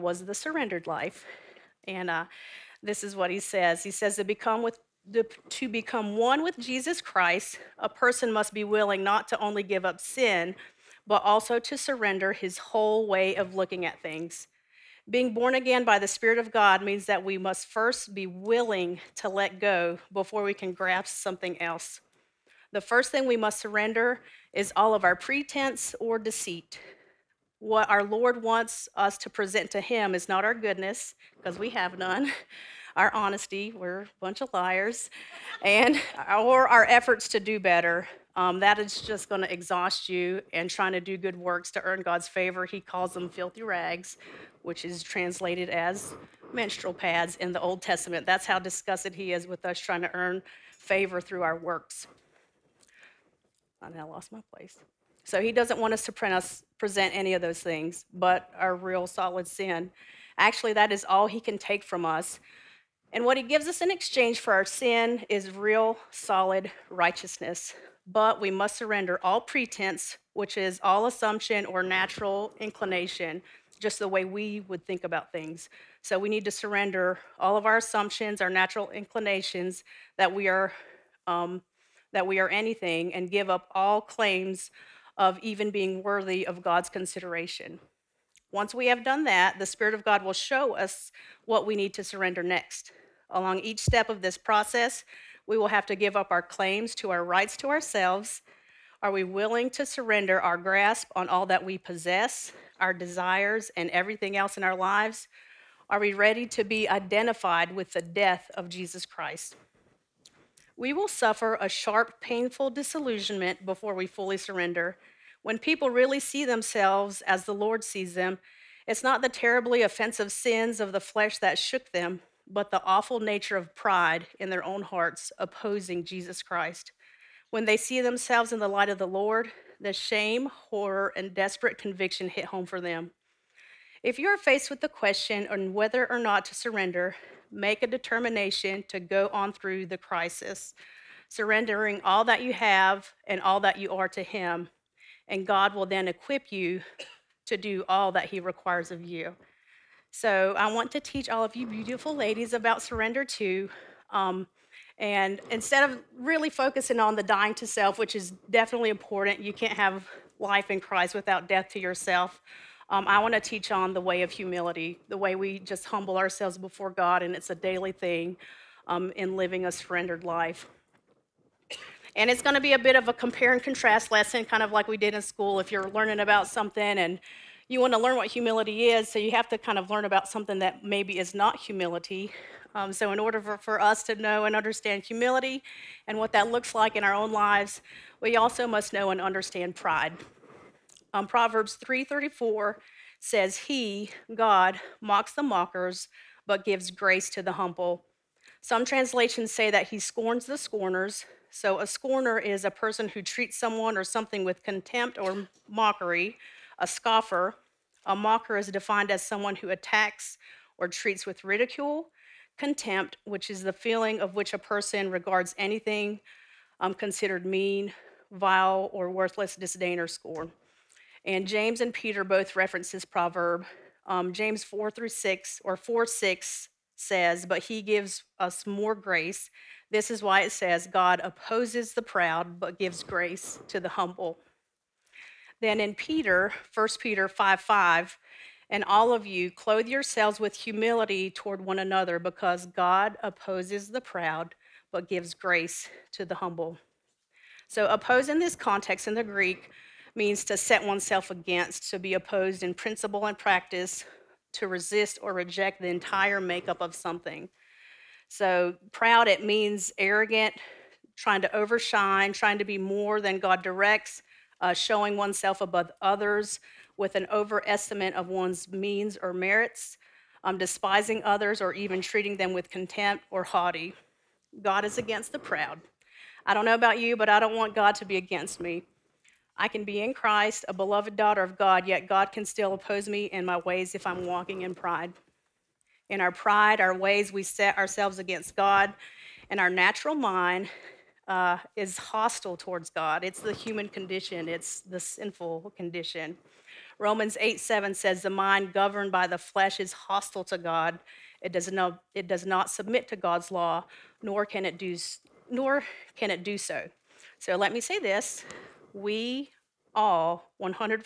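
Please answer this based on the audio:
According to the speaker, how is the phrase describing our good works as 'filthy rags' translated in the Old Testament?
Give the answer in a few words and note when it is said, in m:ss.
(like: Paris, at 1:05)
menstrual pads, at 0:46.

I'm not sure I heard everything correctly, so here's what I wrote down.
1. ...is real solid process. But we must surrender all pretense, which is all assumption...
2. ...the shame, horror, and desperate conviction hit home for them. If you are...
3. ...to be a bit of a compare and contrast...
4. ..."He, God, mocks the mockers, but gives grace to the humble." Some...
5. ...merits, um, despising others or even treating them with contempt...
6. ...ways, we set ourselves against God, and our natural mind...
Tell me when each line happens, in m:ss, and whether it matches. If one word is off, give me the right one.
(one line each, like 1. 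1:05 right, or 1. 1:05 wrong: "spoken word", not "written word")
1. 1:05 wrong: "righteousness", not "process"
2. 2:09 right
3. 2:52 right
4. 3:13 right
5. 4:29 right
6. 4:46 right.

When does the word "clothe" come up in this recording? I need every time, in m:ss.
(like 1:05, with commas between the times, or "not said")
3:59.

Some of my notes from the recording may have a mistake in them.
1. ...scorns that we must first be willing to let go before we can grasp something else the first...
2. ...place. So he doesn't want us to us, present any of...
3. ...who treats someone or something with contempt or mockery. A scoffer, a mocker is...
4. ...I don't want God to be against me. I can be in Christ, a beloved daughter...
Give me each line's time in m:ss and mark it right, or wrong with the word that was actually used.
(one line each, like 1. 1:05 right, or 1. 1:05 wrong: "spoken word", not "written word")
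1. 0:16 wrong: "means", not "scorns"
2. 0:54 right
3. 3:23 right
4. 4:37 right.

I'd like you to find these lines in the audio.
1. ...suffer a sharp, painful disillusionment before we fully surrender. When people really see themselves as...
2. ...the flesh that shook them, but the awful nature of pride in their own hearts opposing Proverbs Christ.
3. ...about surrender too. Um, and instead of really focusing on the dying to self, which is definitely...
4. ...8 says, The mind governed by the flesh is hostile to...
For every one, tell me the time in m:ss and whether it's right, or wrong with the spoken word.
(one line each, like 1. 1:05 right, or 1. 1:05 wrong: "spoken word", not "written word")
1. 1:51 right
2. 2:00 wrong: "Jesus", not "Proverbs"
3. 2:32 right
4. 4:57 wrong: "7", not "8".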